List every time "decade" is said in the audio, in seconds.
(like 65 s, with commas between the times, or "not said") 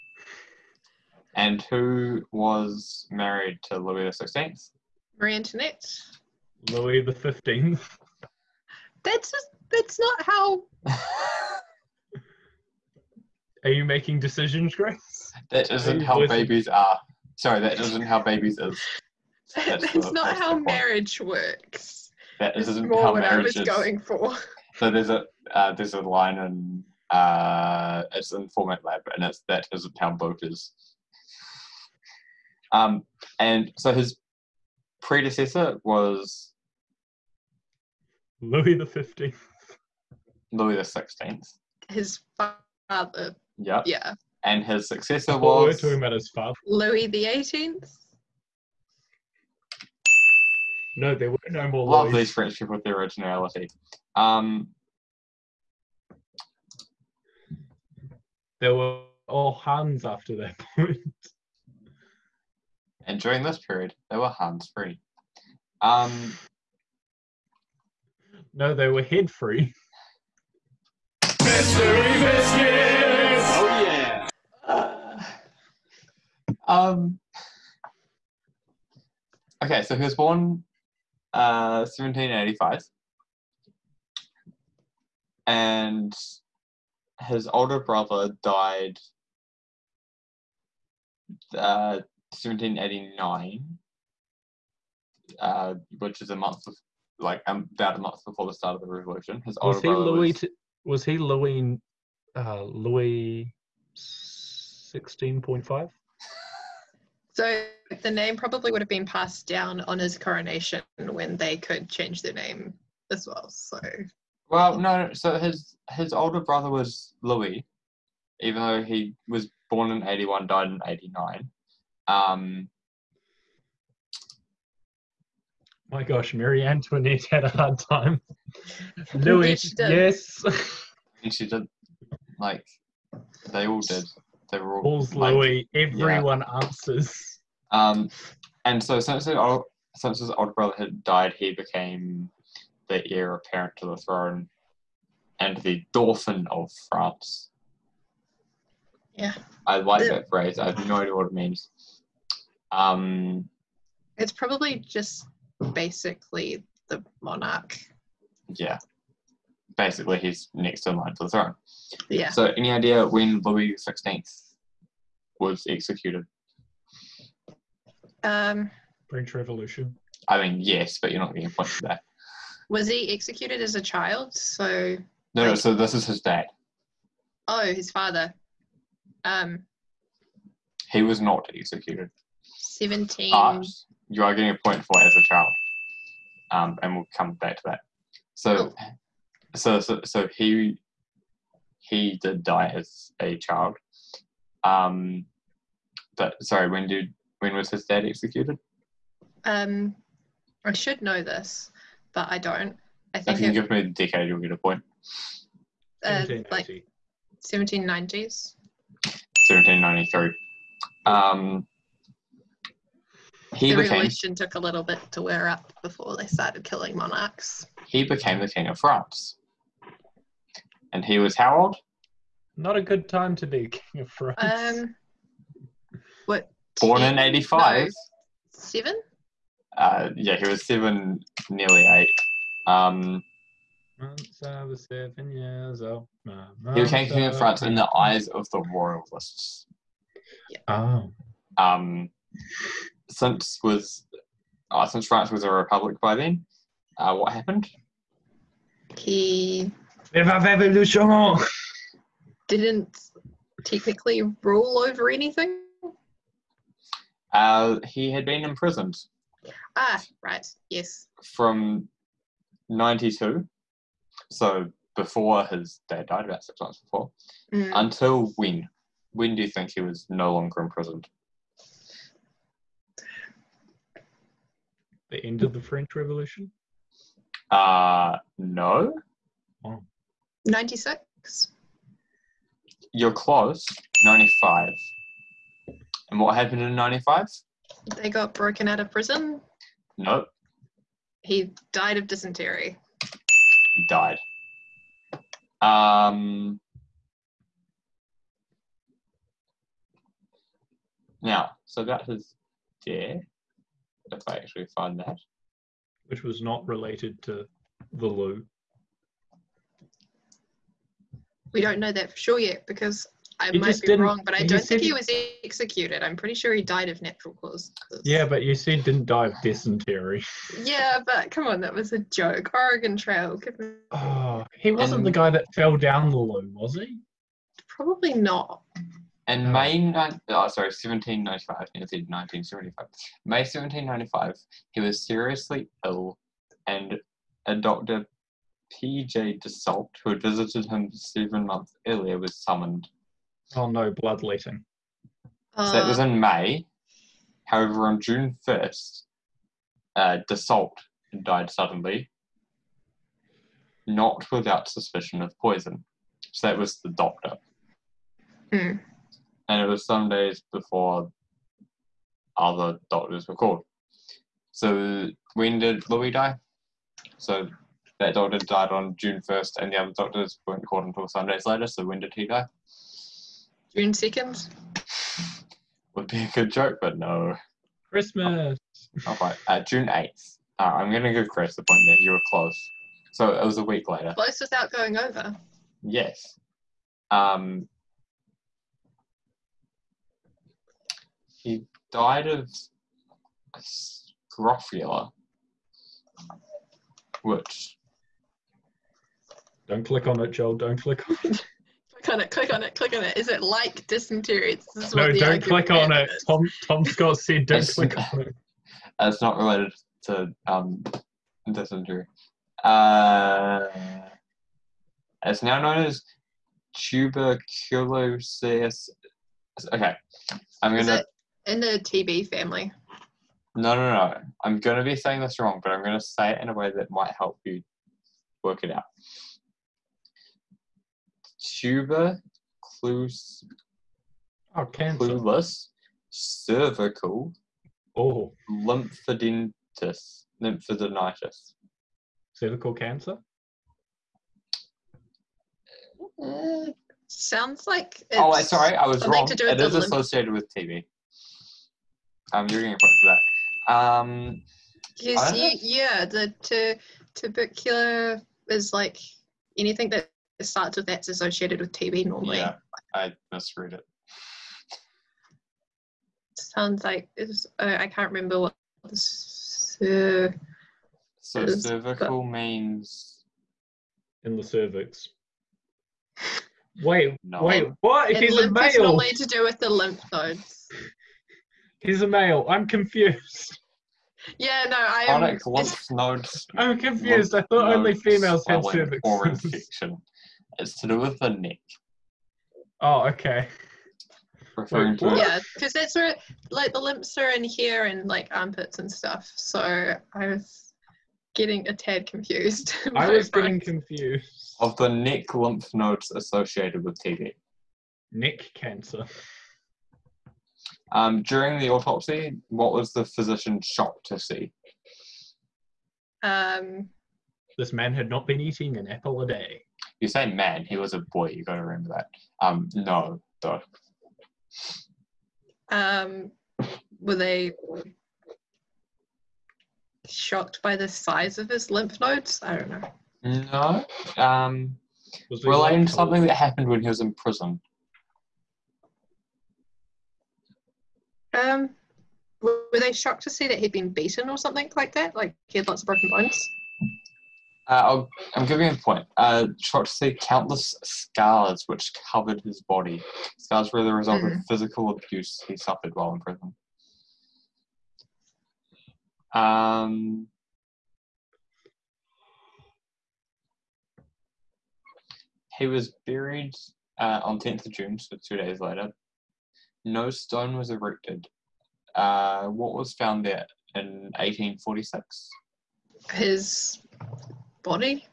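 203 s.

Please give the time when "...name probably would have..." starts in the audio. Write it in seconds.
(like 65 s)
108 s.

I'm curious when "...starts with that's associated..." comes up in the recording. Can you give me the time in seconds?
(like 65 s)
460 s.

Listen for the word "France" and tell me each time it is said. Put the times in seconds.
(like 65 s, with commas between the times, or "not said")
146 s, 218 s, 224 s, 237 s, 245 s.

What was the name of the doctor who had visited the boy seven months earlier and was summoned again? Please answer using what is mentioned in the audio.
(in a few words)
P.J. Desault.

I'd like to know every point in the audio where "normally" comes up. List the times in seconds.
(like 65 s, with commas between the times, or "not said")
462 s, 478 s.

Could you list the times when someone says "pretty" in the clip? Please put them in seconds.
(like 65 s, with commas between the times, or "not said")
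316 s.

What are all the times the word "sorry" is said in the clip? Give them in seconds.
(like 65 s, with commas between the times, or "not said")
17 s, 196 s, 330 s, 448 s.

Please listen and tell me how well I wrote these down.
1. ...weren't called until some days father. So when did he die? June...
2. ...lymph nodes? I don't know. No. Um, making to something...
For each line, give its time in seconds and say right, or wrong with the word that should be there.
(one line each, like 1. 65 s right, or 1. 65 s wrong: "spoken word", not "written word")
1. 370 s wrong: "later", not "father"
2. 531 s wrong: "relating", not "making".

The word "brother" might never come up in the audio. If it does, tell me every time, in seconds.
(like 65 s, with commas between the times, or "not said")
87 s, 99 s, 116 s, 140 s.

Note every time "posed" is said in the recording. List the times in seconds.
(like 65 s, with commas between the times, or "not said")
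not said.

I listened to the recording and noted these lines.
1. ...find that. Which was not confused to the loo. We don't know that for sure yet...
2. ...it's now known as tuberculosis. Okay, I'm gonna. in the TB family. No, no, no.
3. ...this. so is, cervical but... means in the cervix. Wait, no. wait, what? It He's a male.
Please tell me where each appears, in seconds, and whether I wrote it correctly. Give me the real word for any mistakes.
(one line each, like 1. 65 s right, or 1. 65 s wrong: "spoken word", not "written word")
1. 304 s wrong: "related", not "confused"
2. 415 s right
3. 468 s right.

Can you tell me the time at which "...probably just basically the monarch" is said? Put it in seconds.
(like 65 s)
154 s.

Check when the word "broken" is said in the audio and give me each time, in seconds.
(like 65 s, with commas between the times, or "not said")
288 s, 545 s.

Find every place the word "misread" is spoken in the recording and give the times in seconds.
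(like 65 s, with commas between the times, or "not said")
463 s.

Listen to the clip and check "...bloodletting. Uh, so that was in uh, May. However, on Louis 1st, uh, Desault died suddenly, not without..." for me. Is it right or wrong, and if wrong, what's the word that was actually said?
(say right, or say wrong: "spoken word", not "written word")
wrong: "June", not "Louis".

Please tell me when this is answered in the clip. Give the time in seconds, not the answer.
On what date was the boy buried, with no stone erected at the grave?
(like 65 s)
567 s.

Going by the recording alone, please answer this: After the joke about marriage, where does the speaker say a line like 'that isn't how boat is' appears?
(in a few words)
Format Lab.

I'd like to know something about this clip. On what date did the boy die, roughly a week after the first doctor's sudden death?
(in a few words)
June 8.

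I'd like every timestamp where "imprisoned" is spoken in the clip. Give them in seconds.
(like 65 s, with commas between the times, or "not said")
258 s, 270 s.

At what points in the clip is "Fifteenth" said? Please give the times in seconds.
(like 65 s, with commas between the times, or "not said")
7 s, 38 s.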